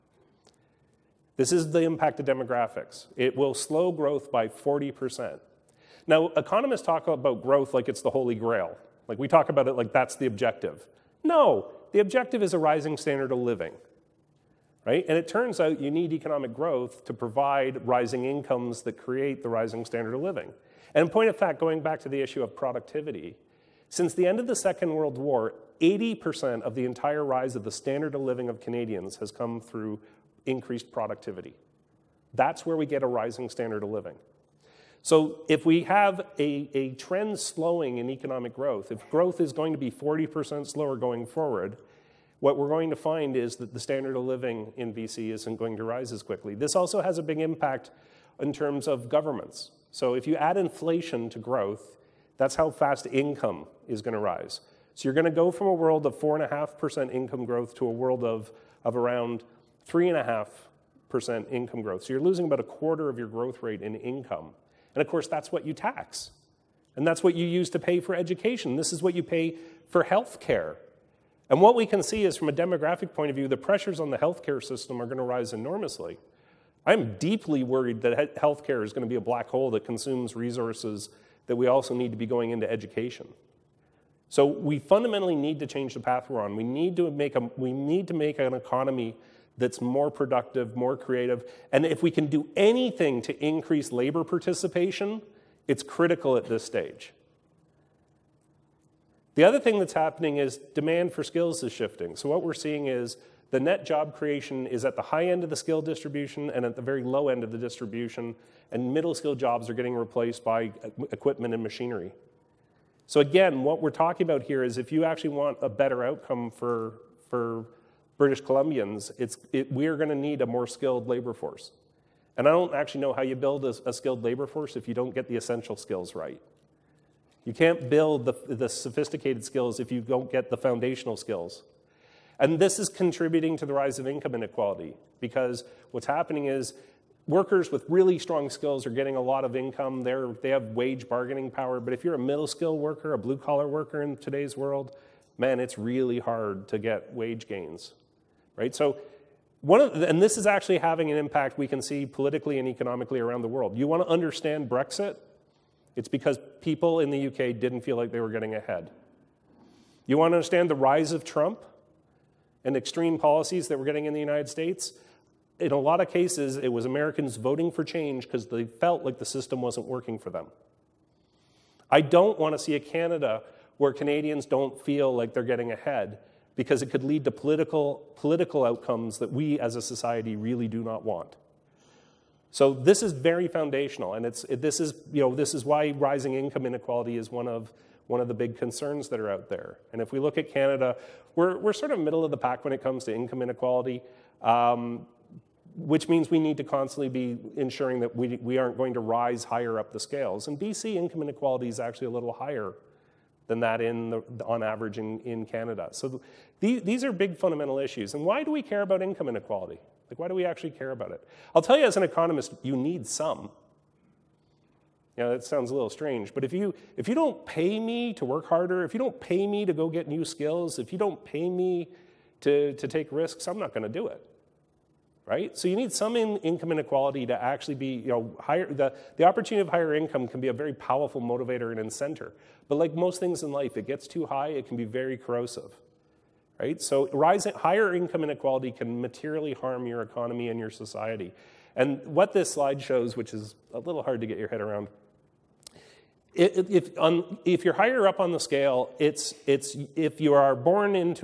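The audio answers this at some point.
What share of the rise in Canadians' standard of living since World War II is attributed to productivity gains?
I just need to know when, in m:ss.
0:25.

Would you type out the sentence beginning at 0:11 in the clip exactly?
No, the objective is a rising standard of living.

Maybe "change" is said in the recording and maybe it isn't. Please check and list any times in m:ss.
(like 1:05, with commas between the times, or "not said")
1:25, 2:47.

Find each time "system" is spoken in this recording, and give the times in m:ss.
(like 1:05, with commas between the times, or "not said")
1:14, 2:49.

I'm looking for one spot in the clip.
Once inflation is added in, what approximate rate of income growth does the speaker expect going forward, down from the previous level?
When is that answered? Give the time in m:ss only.
0:59.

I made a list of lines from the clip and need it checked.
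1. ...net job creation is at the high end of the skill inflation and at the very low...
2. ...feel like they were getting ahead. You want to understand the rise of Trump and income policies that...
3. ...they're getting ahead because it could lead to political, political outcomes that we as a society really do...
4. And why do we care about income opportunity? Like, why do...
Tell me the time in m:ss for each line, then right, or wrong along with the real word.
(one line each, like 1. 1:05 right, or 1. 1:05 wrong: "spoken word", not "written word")
1. 1:43 wrong: "distribution", not "inflation"
2. 2:37 wrong: "extreme", not "income"
3. 2:55 right
4. 3:28 wrong: "inequality", not "opportunity".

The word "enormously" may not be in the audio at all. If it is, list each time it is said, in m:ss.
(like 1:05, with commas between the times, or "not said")
1:15.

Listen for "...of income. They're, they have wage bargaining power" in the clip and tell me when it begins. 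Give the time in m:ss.
2:19.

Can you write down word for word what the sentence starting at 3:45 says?
So you need some in income inequality to actually be, you know, higher.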